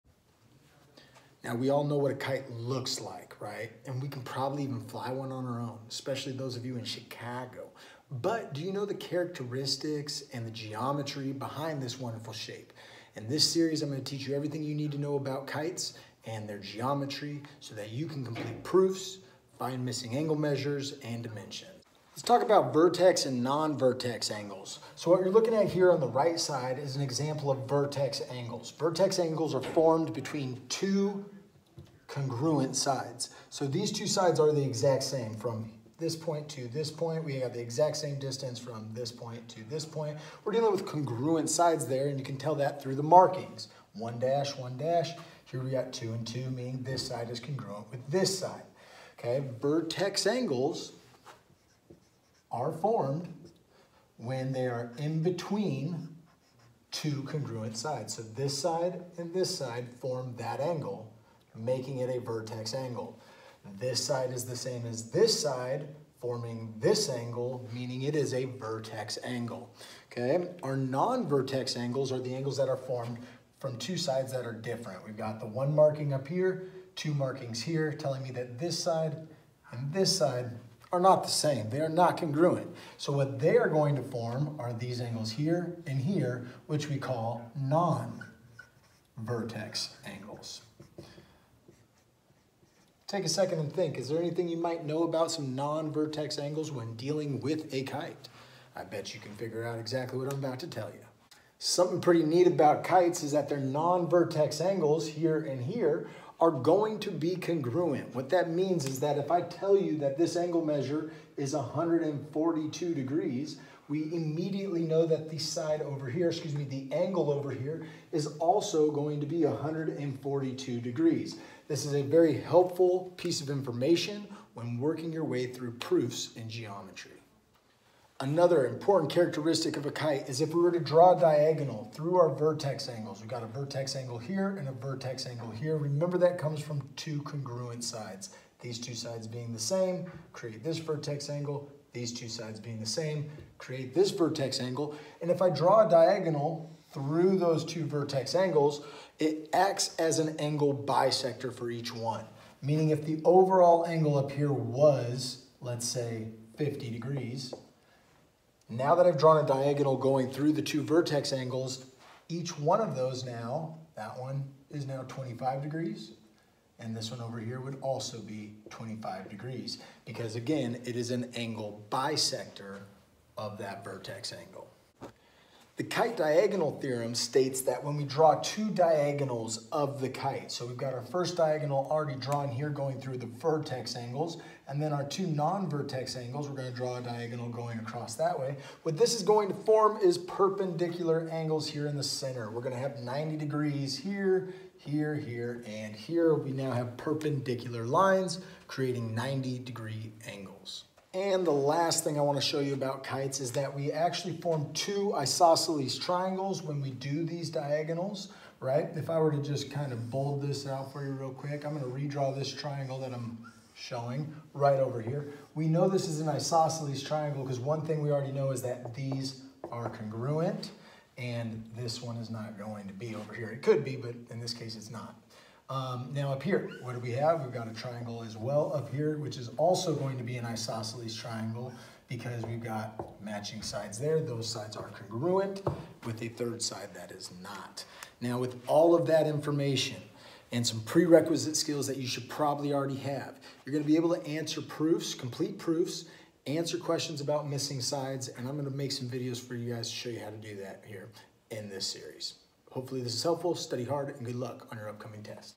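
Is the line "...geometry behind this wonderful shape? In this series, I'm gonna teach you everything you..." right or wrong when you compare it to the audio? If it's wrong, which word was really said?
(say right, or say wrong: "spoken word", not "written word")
right.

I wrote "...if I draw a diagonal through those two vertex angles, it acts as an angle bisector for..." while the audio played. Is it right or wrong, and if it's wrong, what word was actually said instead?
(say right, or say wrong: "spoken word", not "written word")
right.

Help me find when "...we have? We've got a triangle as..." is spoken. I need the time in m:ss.
3:46.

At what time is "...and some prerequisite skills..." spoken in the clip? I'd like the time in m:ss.
4:00.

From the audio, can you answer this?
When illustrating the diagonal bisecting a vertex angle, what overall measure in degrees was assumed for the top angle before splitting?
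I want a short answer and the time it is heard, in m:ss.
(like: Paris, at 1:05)
50 degrees, at 2:36.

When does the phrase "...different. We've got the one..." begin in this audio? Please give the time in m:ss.
1:14.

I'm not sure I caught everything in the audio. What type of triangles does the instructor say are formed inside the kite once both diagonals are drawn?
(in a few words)
isosceles triangles.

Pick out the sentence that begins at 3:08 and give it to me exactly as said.
What this is going to form is perpendicular angles here in the center.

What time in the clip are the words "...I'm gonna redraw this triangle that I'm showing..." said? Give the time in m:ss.
3:31.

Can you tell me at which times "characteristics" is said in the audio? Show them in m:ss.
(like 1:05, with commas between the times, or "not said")
0:08, 2:09.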